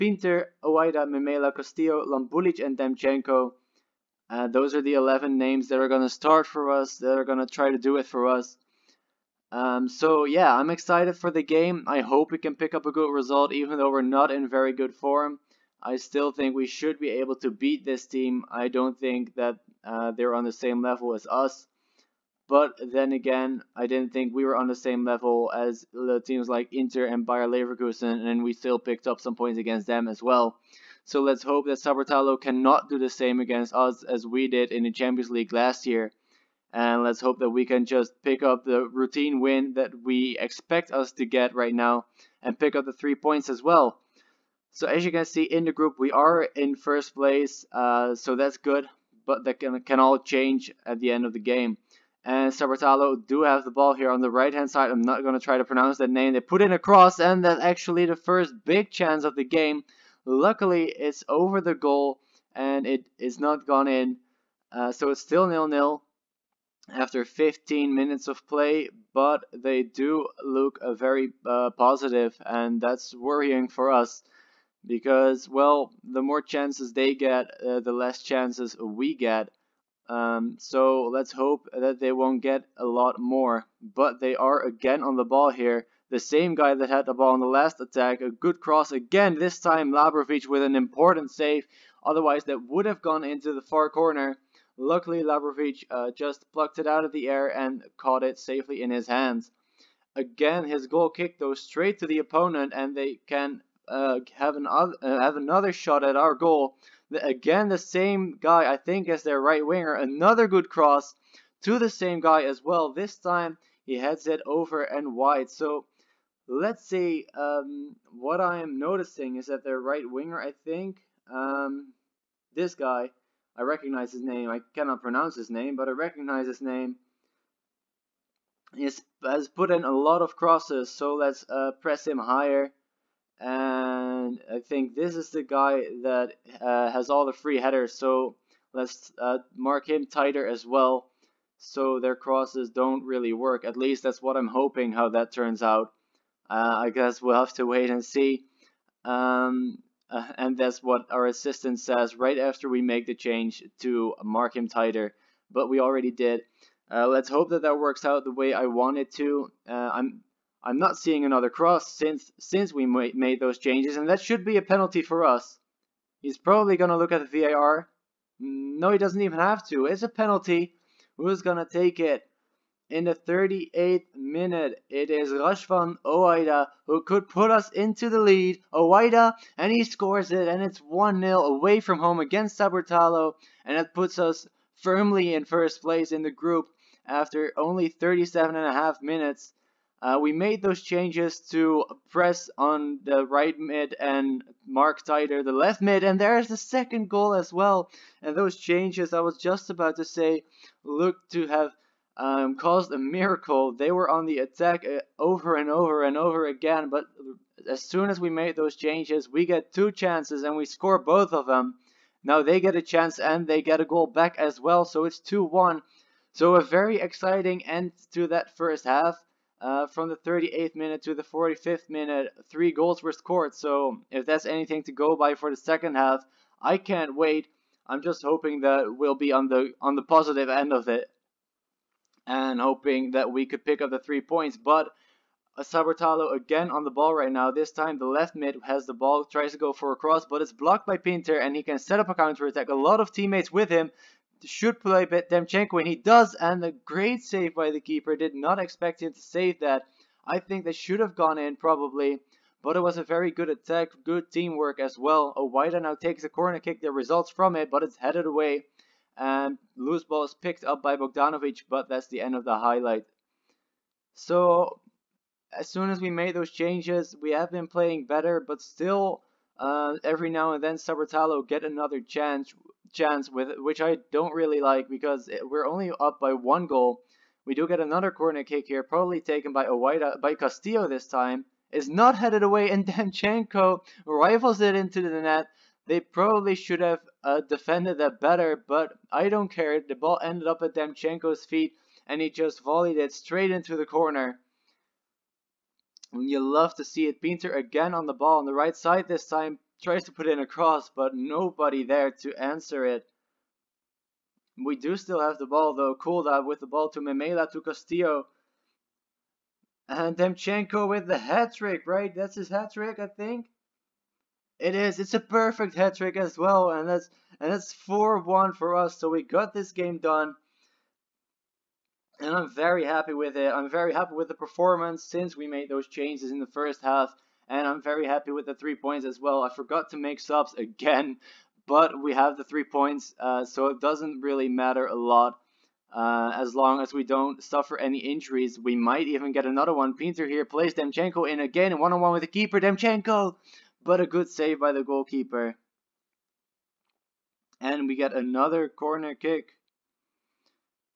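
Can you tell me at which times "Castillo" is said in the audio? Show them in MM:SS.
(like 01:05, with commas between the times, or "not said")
00:01, 04:40, 05:07.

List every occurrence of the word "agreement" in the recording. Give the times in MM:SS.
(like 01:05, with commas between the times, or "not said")
not said.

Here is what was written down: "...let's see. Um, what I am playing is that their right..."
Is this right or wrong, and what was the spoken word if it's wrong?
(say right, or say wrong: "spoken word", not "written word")
wrong: "noticing", not "playing".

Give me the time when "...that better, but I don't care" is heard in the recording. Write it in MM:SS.
04:47.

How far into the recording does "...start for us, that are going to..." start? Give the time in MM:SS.
00:06.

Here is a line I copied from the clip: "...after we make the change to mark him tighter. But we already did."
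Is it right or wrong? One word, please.
right.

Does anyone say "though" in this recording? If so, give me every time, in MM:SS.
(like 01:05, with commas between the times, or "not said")
00:13, 05:05.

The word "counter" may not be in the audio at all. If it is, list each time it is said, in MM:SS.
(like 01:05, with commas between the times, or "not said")
04:02.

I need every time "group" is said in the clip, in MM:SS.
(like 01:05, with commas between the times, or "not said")
00:45, 03:06.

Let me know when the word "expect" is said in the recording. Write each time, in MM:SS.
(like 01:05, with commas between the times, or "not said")
00:40, 04:08.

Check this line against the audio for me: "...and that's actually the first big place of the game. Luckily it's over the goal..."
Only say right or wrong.
wrong.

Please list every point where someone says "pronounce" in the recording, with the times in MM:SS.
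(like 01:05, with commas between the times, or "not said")
00:55, 02:05.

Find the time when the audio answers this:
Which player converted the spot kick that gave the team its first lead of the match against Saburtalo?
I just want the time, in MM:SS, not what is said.
02:55.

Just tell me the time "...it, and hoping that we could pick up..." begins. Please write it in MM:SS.
03:50.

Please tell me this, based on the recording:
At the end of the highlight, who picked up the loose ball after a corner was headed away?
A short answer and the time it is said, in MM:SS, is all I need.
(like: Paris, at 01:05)
Bogdanovic, at 04:20.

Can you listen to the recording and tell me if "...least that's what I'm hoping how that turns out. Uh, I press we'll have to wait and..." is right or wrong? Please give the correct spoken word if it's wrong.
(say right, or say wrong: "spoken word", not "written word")
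wrong: "guess", not "press".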